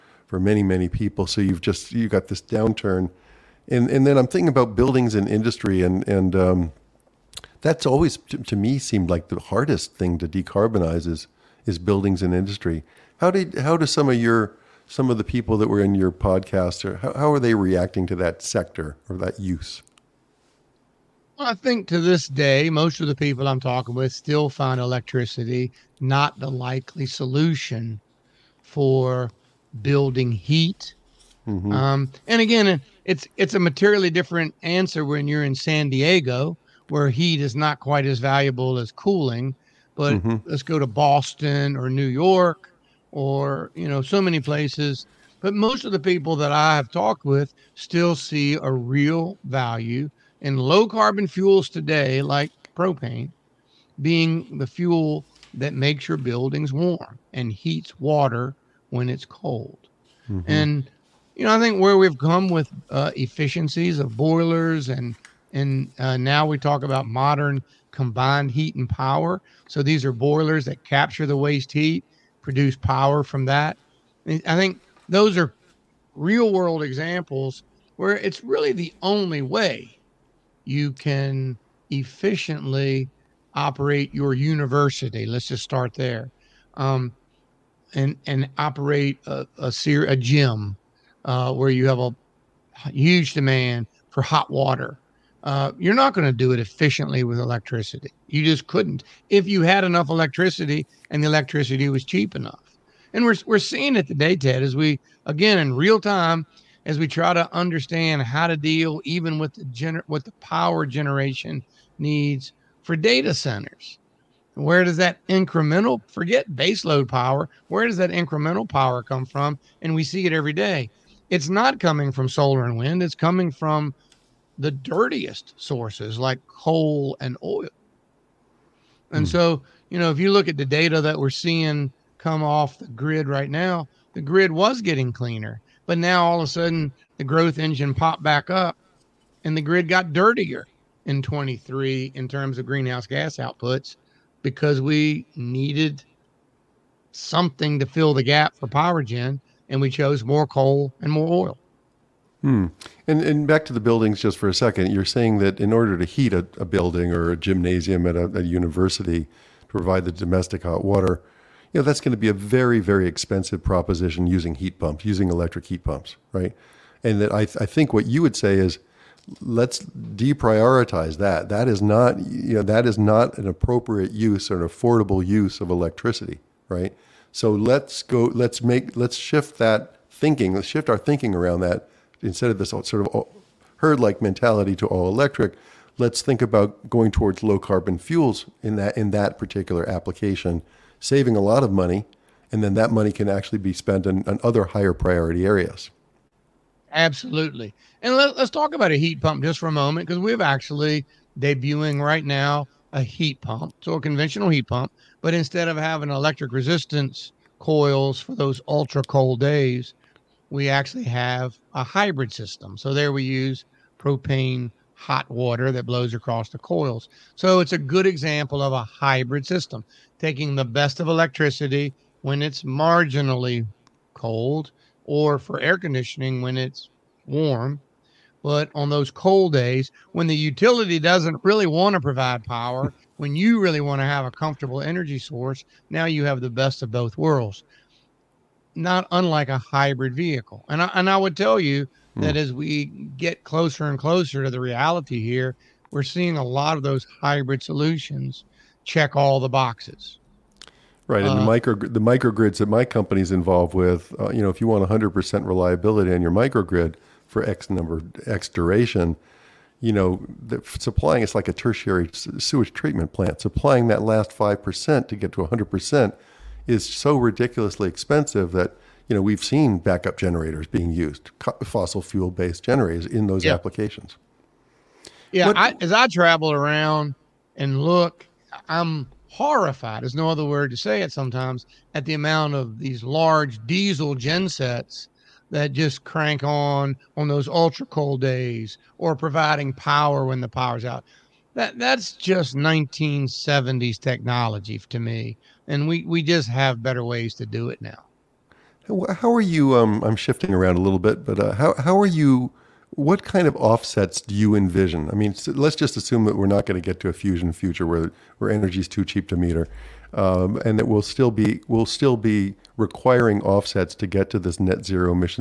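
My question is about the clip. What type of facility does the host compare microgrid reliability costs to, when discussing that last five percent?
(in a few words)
tertiary sewage treatment plant.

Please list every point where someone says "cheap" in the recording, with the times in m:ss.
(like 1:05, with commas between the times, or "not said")
1:42, 5:09.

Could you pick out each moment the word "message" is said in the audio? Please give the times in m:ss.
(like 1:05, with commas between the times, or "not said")
not said.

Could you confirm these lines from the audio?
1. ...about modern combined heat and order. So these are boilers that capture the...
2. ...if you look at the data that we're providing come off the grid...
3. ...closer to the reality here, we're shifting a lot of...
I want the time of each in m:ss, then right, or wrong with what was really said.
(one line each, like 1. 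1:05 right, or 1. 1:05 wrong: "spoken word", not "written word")
1. 1:06 wrong: "power", not "order"
2. 2:10 wrong: "seeing", not "providing"
3. 4:03 wrong: "seeing", not "shifting".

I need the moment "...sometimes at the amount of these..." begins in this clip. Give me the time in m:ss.
4:41.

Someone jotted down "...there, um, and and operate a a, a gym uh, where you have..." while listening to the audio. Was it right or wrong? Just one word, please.
right.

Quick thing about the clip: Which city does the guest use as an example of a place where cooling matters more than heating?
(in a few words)
San Diego.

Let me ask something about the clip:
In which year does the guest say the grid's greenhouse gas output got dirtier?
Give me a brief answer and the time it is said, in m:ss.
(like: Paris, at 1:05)
2023, at 2:21.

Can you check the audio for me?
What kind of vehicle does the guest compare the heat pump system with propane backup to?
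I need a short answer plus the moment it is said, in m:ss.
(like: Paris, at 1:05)
hybrid vehicle, at 3:59.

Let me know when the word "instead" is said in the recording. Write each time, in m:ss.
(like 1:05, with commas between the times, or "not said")
3:02, 3:25.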